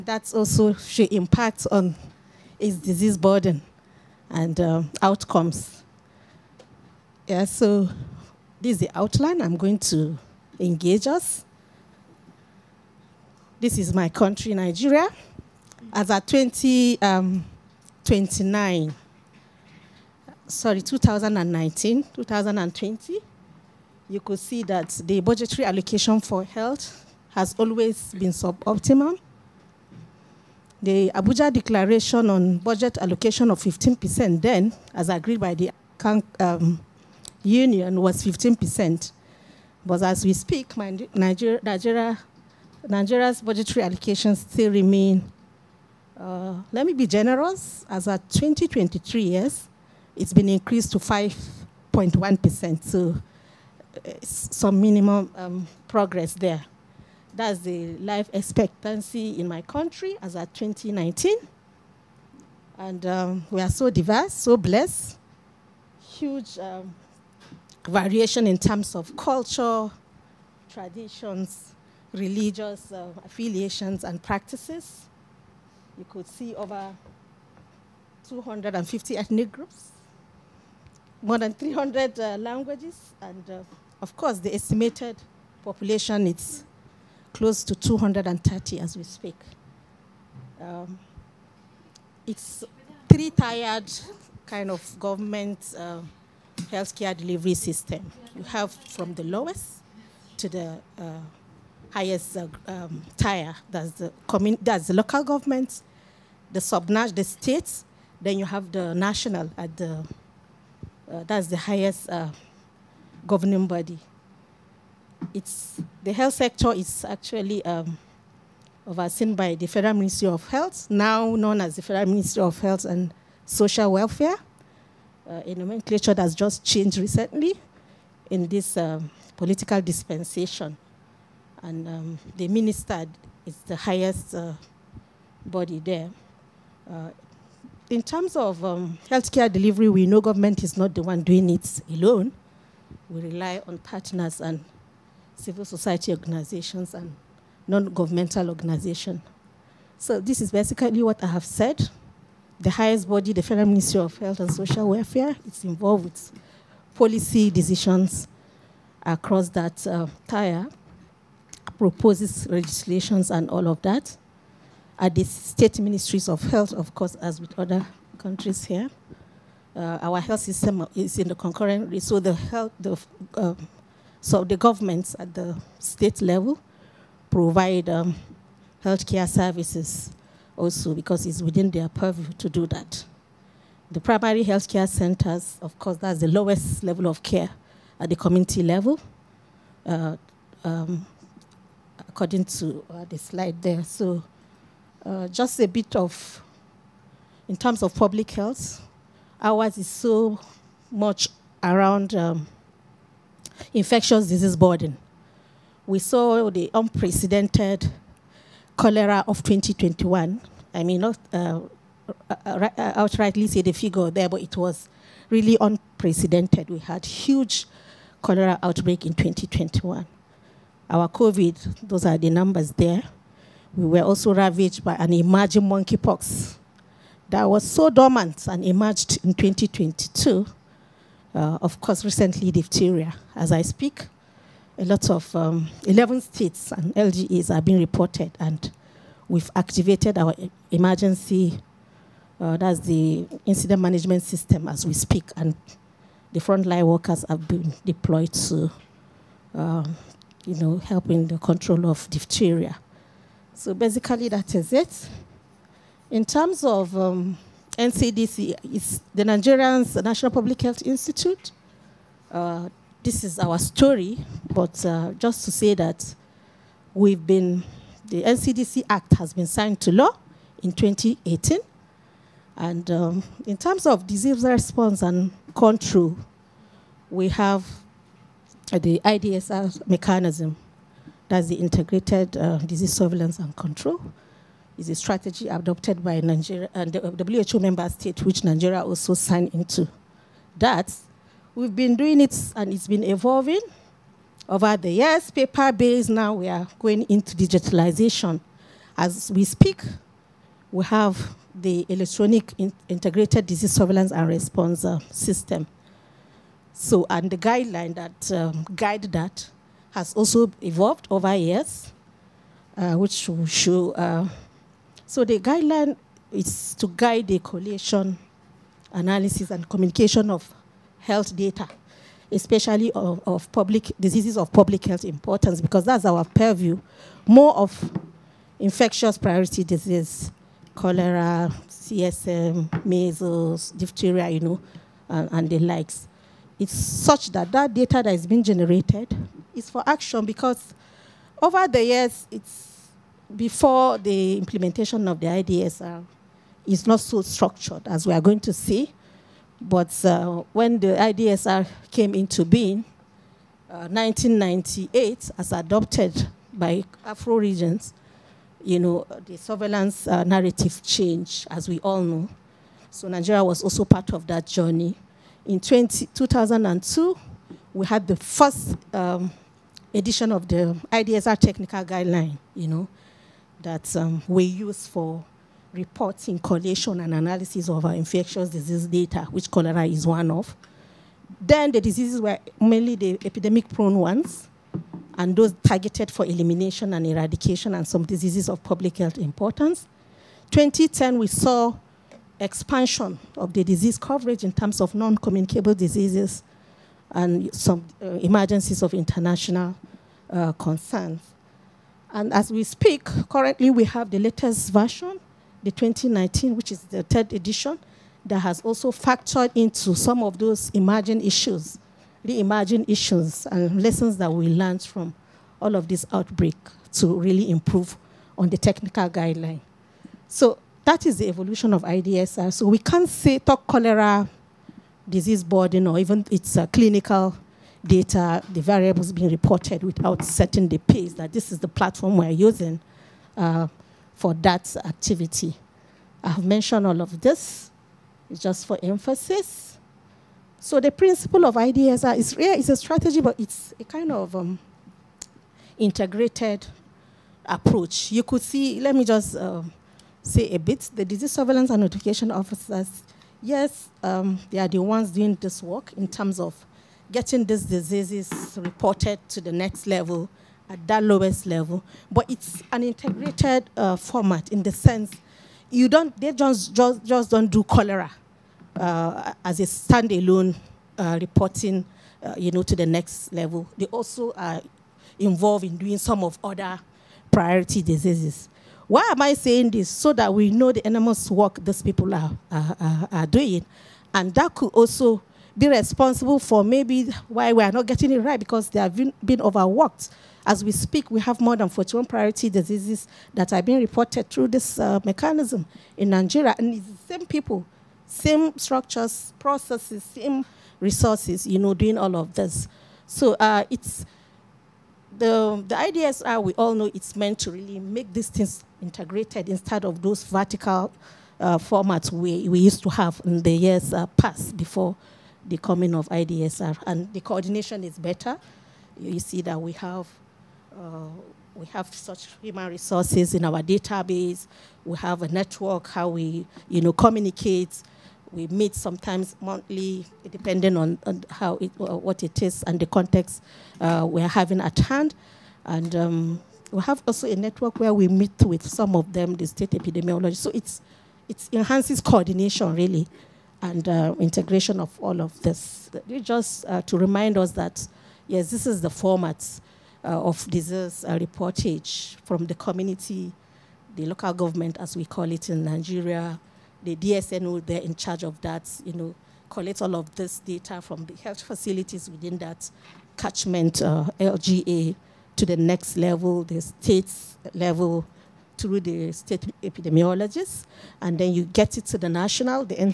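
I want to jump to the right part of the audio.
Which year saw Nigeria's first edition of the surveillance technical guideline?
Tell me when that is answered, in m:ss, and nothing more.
6:06.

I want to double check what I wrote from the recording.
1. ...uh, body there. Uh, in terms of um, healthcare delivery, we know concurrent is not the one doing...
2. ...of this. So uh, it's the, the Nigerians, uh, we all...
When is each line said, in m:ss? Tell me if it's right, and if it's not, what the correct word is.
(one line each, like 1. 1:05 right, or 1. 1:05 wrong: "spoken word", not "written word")
1. 2:14 wrong: "government", not "concurrent"
2. 8:22 wrong: "IDSR", not "Nigerians".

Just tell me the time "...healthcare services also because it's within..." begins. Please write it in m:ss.
2:58.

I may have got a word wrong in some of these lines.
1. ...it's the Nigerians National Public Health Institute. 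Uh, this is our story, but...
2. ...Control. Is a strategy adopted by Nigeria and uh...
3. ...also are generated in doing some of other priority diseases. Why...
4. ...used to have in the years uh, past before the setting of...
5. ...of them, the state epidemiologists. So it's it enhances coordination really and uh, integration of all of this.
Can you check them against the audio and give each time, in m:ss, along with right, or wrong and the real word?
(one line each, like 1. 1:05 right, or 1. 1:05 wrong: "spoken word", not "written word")
1. 4:18 right
2. 4:43 right
3. 7:53 wrong: "involved", not "generated"
4. 8:32 wrong: "coming", not "setting"
5. 8:58 right.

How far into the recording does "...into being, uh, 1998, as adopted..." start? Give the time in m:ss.
5:52.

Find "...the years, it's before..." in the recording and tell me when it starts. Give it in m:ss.
5:41.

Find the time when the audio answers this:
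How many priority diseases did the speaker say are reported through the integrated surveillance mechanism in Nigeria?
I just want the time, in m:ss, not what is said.
8:11.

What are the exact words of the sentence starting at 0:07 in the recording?
Yeah, so this is the outline.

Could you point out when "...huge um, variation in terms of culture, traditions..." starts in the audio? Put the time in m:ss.
1:06.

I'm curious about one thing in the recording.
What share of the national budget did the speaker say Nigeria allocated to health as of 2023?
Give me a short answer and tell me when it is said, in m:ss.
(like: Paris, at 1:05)
5.1%, at 0:50.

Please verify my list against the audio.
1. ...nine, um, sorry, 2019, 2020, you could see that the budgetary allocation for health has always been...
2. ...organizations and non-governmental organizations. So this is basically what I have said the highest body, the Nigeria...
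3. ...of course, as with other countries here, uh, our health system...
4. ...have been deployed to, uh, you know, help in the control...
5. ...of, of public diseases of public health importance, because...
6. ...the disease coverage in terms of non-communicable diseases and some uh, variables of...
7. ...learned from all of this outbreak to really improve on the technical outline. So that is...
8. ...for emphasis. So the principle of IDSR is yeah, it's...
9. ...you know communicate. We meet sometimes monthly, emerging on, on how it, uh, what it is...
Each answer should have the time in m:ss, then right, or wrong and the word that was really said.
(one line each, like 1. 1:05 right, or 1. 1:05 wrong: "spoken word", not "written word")
1. 0:18 right
2. 2:26 wrong: "Federal", not "Nigeria"
3. 2:46 right
4. 4:07 right
5. 5:22 right
6. 6:33 wrong: "emergencies", not "variables"
7. 6:54 wrong: "guideline", not "outline"
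8. 7:18 right
9. 8:46 wrong: "depending", not "emerging".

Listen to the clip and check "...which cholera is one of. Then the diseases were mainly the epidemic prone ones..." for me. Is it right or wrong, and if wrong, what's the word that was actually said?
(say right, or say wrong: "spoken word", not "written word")
right.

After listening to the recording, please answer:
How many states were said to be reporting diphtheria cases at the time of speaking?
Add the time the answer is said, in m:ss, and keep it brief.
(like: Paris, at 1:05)
11, at 3:55.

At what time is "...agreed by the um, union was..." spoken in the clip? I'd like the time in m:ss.
0:35.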